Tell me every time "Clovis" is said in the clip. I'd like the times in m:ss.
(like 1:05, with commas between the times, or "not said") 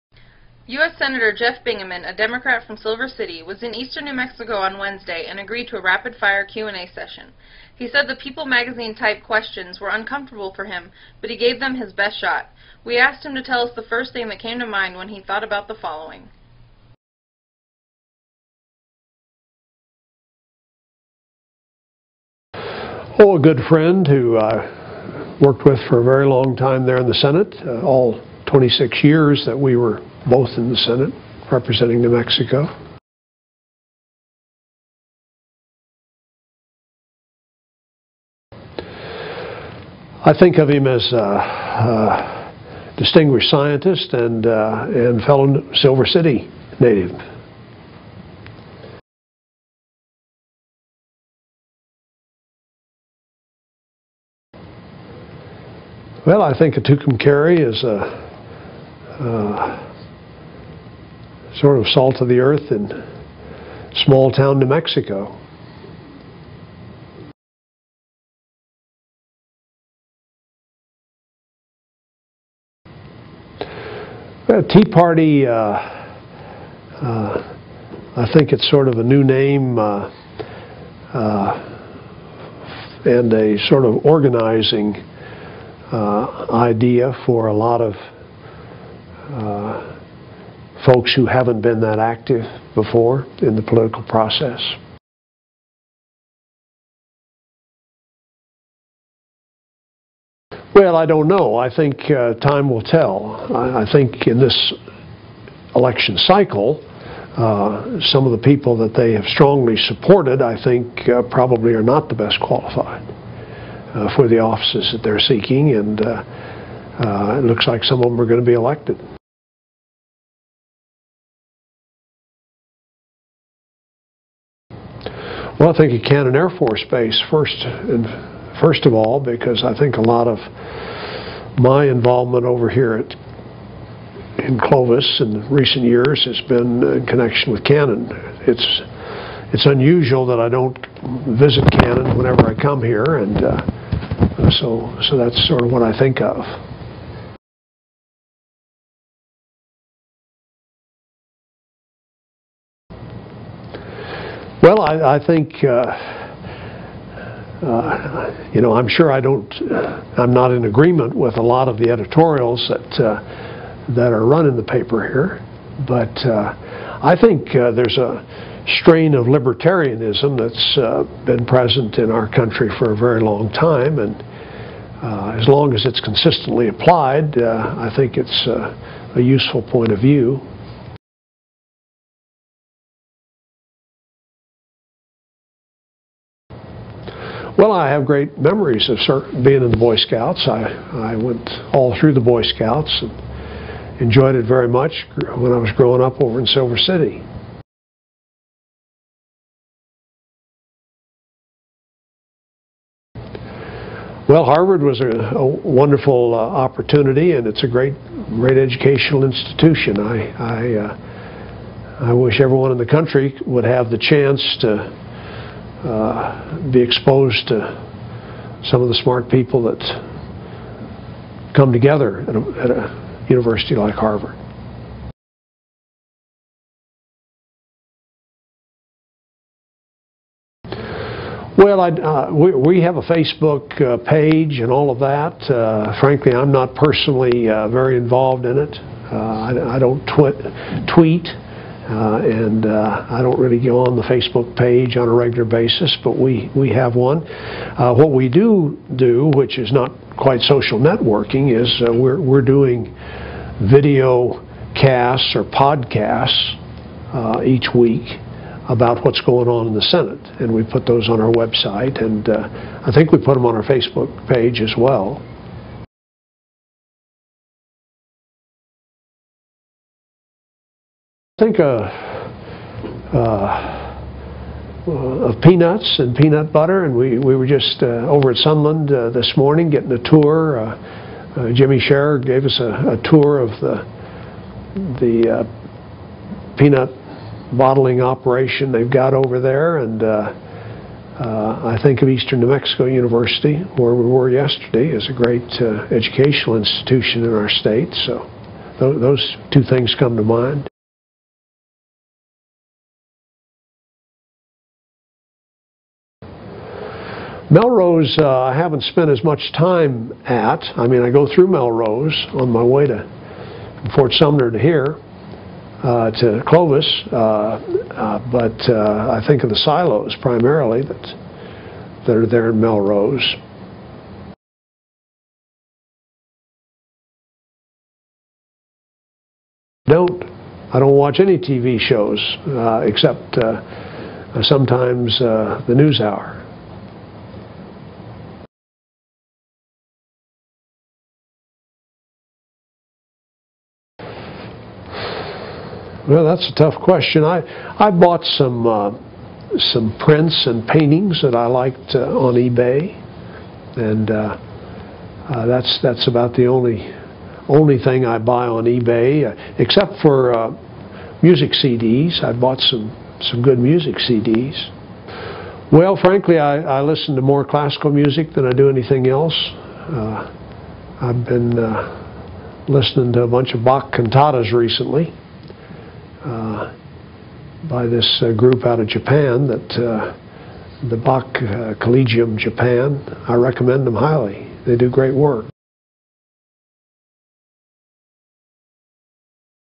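2:14, 5:16.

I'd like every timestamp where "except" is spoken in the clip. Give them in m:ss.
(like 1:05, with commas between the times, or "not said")
5:32, 5:59.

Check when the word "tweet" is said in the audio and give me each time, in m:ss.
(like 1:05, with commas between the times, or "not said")
4:00.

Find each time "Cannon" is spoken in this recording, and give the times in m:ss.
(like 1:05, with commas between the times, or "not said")
2:06, 2:17, 2:21.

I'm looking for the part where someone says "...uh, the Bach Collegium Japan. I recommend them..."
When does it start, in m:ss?
6:19.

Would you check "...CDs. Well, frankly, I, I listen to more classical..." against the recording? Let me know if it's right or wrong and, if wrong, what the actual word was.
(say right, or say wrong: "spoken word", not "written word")
right.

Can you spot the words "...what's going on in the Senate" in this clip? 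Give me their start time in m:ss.
4:19.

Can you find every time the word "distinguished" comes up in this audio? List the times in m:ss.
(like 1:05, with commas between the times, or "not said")
0:42.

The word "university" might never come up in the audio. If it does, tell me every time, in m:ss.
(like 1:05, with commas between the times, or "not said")
3:43, 4:52.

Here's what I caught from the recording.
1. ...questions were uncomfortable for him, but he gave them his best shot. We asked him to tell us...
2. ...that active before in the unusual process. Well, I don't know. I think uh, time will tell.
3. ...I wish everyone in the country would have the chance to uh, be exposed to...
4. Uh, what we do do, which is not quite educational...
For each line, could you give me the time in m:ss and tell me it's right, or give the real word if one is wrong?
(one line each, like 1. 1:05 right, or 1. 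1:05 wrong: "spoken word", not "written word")
1. 0:09 right
2. 1:31 wrong: "political", not "unusual"
3. 3:32 right
4. 4:07 wrong: "social", not "educational".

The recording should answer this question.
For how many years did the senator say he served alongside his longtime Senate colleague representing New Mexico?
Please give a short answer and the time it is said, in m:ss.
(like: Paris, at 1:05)
26, at 0:28.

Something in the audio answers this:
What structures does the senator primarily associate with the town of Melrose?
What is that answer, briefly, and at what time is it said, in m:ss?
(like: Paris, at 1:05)
silos, at 5:19.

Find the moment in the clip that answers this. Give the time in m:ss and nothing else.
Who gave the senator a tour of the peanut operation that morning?
4:41.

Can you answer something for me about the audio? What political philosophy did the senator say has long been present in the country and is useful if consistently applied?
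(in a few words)
libertarianism.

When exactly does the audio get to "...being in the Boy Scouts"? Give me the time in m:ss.
3:09.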